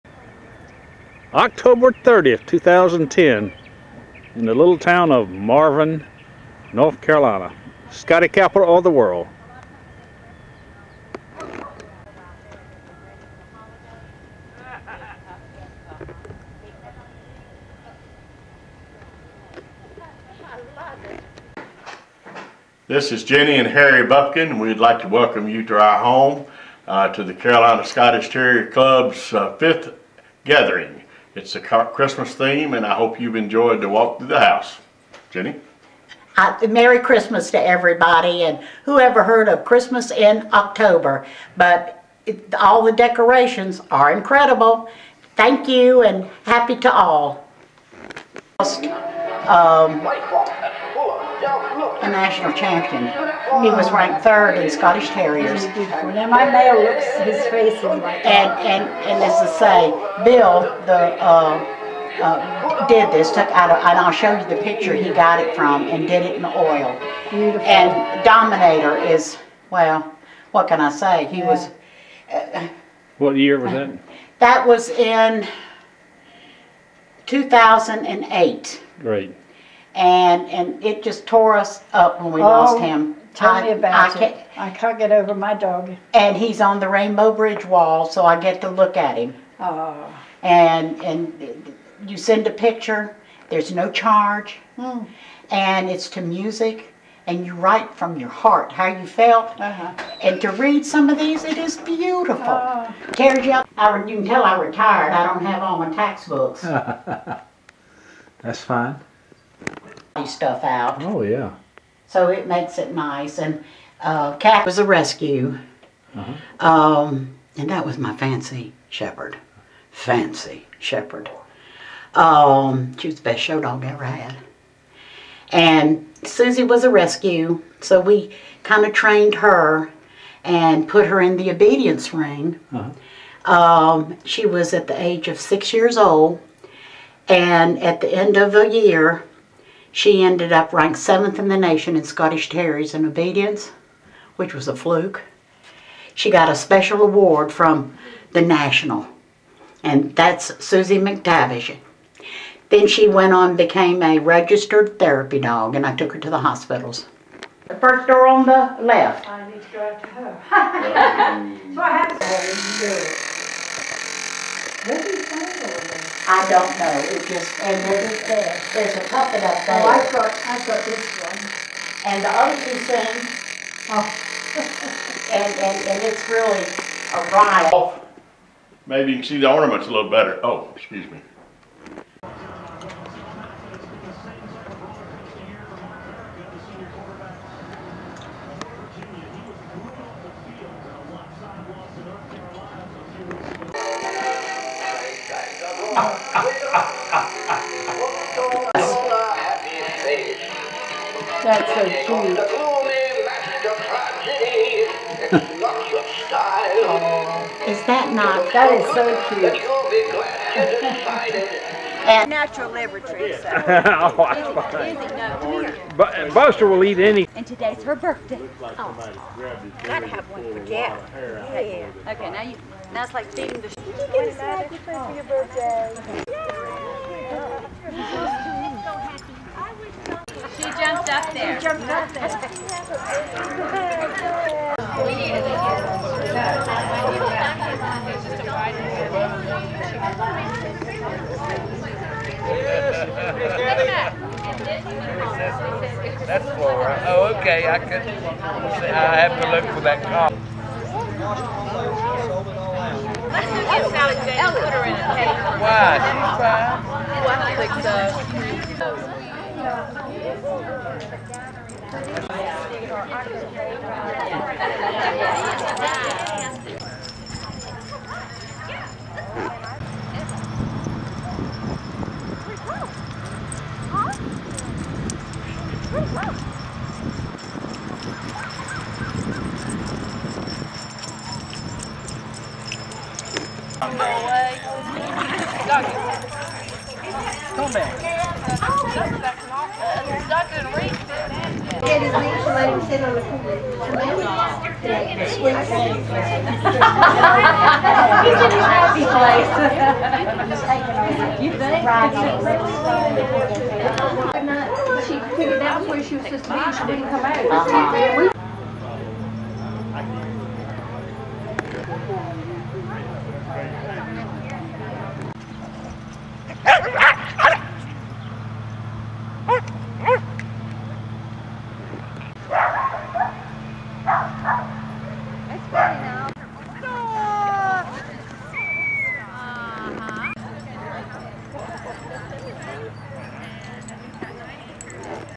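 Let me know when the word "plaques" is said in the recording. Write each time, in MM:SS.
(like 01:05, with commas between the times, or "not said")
not said.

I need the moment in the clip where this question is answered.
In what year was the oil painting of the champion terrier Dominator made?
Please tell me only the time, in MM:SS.
01:17.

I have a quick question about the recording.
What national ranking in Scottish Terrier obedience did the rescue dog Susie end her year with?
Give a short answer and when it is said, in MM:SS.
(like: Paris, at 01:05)
seventh, at 02:20.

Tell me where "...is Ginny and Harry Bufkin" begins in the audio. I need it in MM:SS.
00:23.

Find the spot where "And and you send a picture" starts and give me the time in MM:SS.
01:30.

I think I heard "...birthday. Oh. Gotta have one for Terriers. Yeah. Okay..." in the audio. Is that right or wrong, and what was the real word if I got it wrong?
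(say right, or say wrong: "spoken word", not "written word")
wrong: "Jack", not "Terriers".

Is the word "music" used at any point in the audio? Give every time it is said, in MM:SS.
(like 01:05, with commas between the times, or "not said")
01:36.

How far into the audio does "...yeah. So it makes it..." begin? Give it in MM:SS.
01:51.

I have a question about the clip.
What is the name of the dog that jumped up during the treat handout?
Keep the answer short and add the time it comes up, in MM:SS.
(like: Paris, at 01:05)
Flora, at 04:06.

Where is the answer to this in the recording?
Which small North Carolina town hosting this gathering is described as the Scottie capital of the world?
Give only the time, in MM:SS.
00:05.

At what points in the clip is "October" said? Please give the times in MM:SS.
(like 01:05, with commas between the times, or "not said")
00:01, 00:40.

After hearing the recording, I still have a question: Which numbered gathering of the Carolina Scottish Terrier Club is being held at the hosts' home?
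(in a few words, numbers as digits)
fifth.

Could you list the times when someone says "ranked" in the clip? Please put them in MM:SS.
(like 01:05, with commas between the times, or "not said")
00:53, 02:20.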